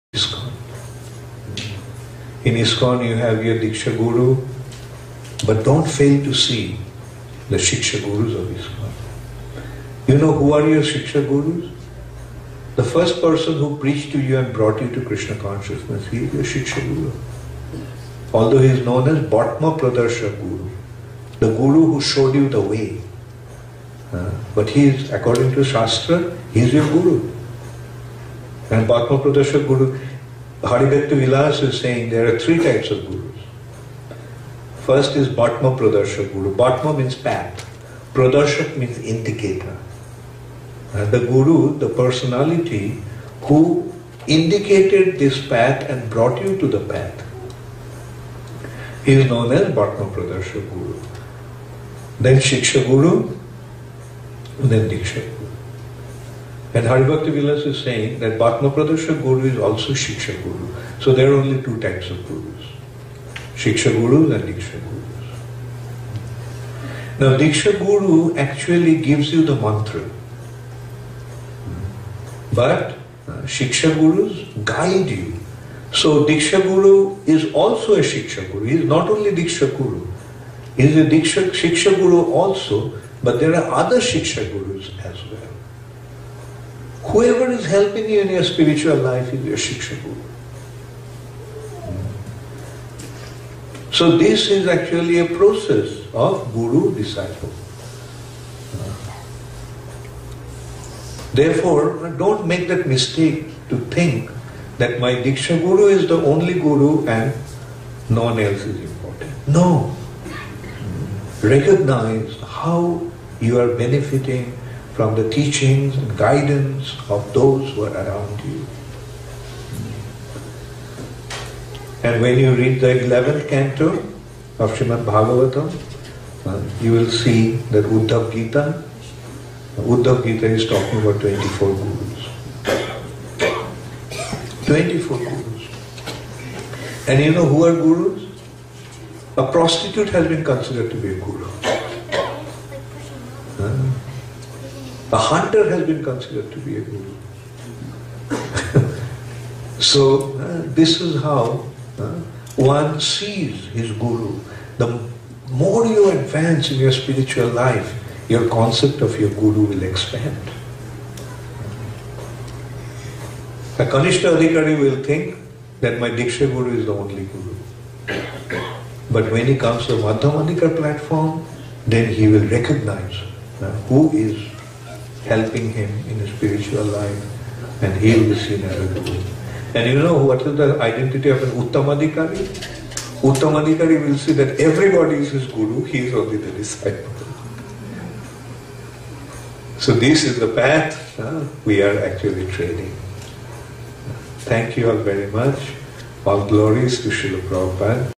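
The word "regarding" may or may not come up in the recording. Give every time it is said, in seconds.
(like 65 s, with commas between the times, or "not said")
not said.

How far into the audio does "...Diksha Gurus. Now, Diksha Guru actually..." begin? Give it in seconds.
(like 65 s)
64 s.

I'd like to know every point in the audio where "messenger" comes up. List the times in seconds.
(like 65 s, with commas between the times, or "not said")
not said.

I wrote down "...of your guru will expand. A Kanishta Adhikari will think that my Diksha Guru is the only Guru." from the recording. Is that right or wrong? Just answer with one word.
right.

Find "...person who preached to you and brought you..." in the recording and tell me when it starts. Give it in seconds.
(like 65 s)
13 s.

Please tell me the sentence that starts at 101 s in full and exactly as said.
Therefore, don't make that mistake to think that my Diksha Guru is the only Guru and no one else is important.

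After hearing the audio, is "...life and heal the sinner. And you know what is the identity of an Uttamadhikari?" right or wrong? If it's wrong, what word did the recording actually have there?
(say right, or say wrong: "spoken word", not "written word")
right.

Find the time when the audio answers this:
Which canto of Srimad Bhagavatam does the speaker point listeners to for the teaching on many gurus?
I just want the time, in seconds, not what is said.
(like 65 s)
123 s.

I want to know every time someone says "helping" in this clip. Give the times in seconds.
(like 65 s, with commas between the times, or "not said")
87 s, 175 s.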